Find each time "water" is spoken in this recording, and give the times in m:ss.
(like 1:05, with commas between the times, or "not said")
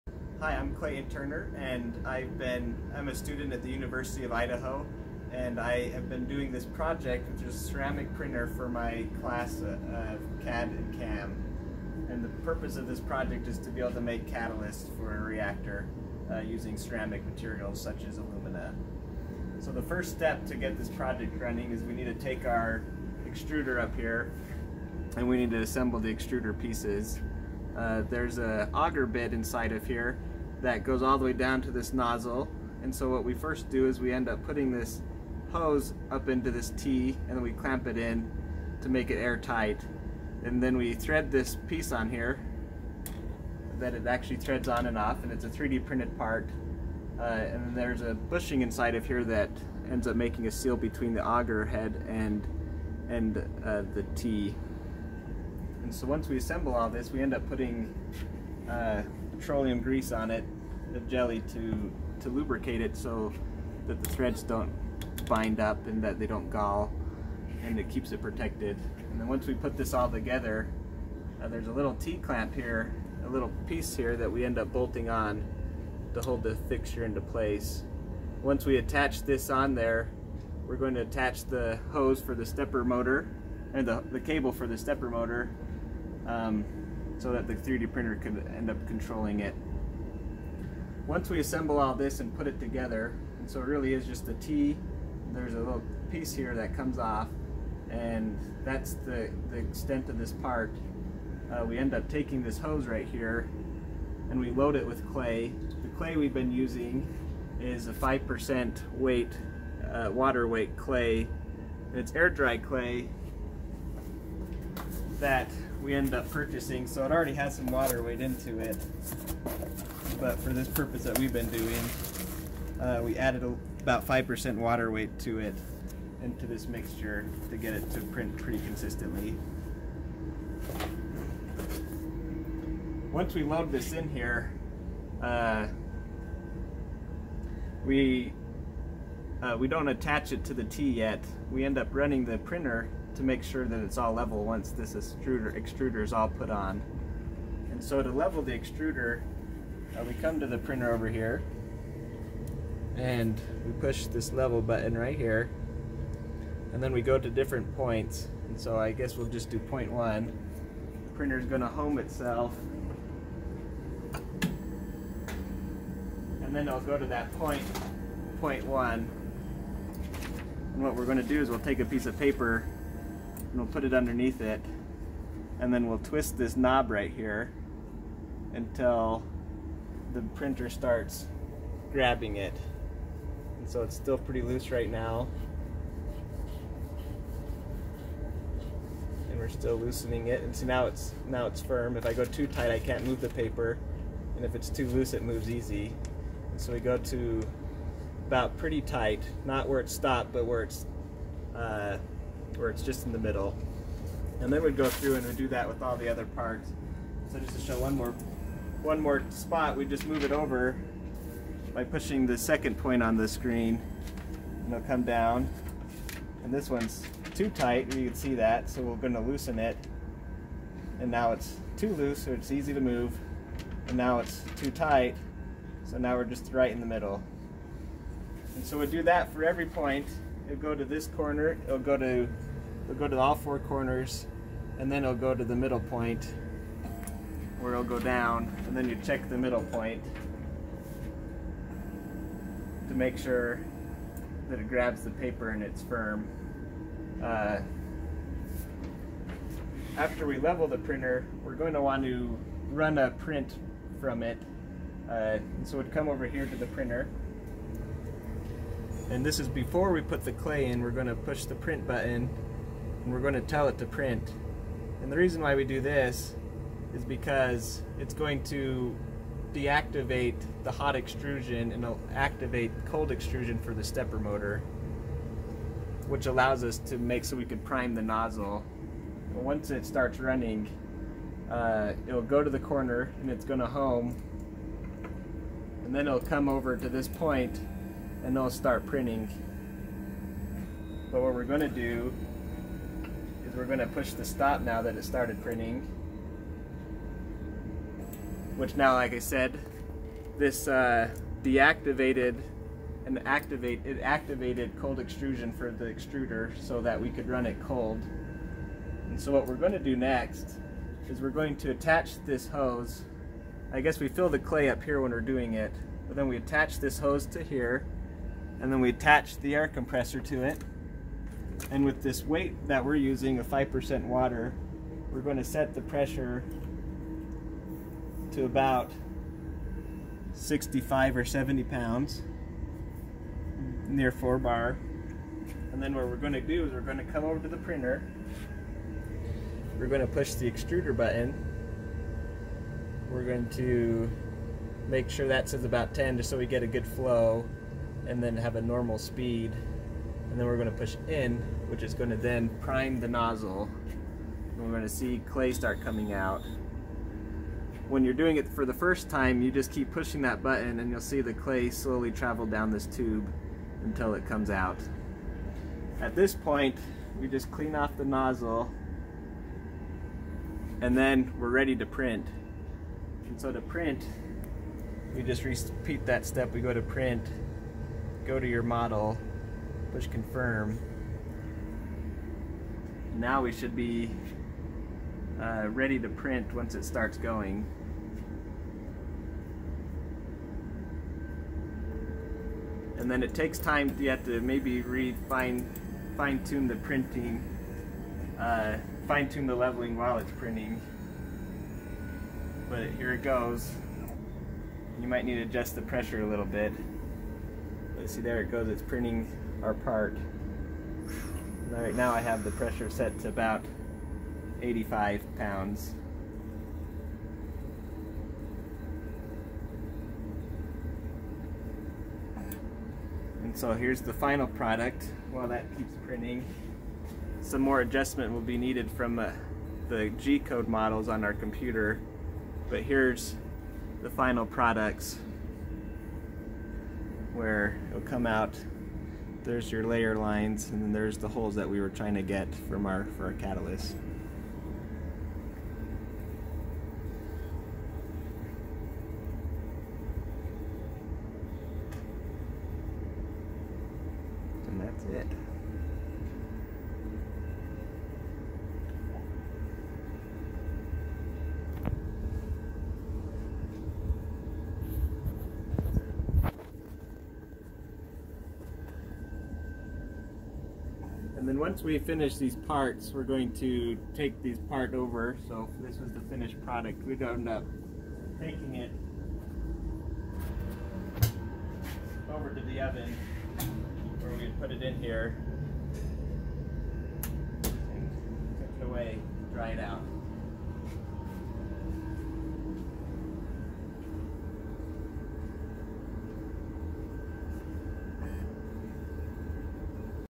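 1:50, 1:57, 2:04, 5:24.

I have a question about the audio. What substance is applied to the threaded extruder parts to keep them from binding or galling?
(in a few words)
petroleum grease.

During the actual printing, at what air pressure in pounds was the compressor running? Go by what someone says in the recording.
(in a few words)
85.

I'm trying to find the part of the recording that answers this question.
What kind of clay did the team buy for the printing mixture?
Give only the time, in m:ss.
1:52.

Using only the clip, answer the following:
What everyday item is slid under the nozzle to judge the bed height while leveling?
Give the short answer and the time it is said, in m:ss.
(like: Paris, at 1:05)
a piece of paper, at 2:51.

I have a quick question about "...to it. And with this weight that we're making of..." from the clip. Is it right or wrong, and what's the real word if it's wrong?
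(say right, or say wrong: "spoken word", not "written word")
wrong: "using", not "making".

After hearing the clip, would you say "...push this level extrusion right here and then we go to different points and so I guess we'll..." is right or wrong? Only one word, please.
wrong.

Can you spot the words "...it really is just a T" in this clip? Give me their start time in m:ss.
1:33.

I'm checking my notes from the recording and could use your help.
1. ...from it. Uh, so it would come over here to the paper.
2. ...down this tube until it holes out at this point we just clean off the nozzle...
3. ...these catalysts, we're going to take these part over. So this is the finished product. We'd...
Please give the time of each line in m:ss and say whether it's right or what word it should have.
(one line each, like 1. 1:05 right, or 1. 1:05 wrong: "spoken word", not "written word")
1. 4:14 wrong: "printer", not "paper"
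2. 6:02 wrong: "comes", not "holes"
3. 7:52 wrong: "parts", not "catalysts".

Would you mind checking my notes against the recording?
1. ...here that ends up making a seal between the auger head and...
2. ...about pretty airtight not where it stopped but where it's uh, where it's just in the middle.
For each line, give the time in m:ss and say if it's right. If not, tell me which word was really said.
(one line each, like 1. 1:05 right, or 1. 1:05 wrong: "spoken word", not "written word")
1. 0:49 right
2. 3:18 wrong: "tight", not "airtight".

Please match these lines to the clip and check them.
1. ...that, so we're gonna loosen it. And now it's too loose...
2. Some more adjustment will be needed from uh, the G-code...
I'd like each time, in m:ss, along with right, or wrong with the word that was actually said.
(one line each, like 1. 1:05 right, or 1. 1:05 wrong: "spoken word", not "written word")
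1. 3:38 right
2. 7:07 right.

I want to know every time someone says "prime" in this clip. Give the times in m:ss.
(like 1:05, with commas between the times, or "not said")
4:37, 5:52.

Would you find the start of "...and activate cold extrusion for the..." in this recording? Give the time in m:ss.
4:31.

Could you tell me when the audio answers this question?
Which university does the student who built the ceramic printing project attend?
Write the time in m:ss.
0:03.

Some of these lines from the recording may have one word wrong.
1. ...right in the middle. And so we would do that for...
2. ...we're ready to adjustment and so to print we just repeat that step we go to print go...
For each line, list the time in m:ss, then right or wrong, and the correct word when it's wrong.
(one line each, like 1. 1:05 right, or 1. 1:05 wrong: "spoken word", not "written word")
1. 3:46 right
2. 6:11 wrong: "print", not "adjustment".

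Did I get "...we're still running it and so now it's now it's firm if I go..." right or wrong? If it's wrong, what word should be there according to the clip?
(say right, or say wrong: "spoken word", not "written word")
wrong: "loosening", not "running".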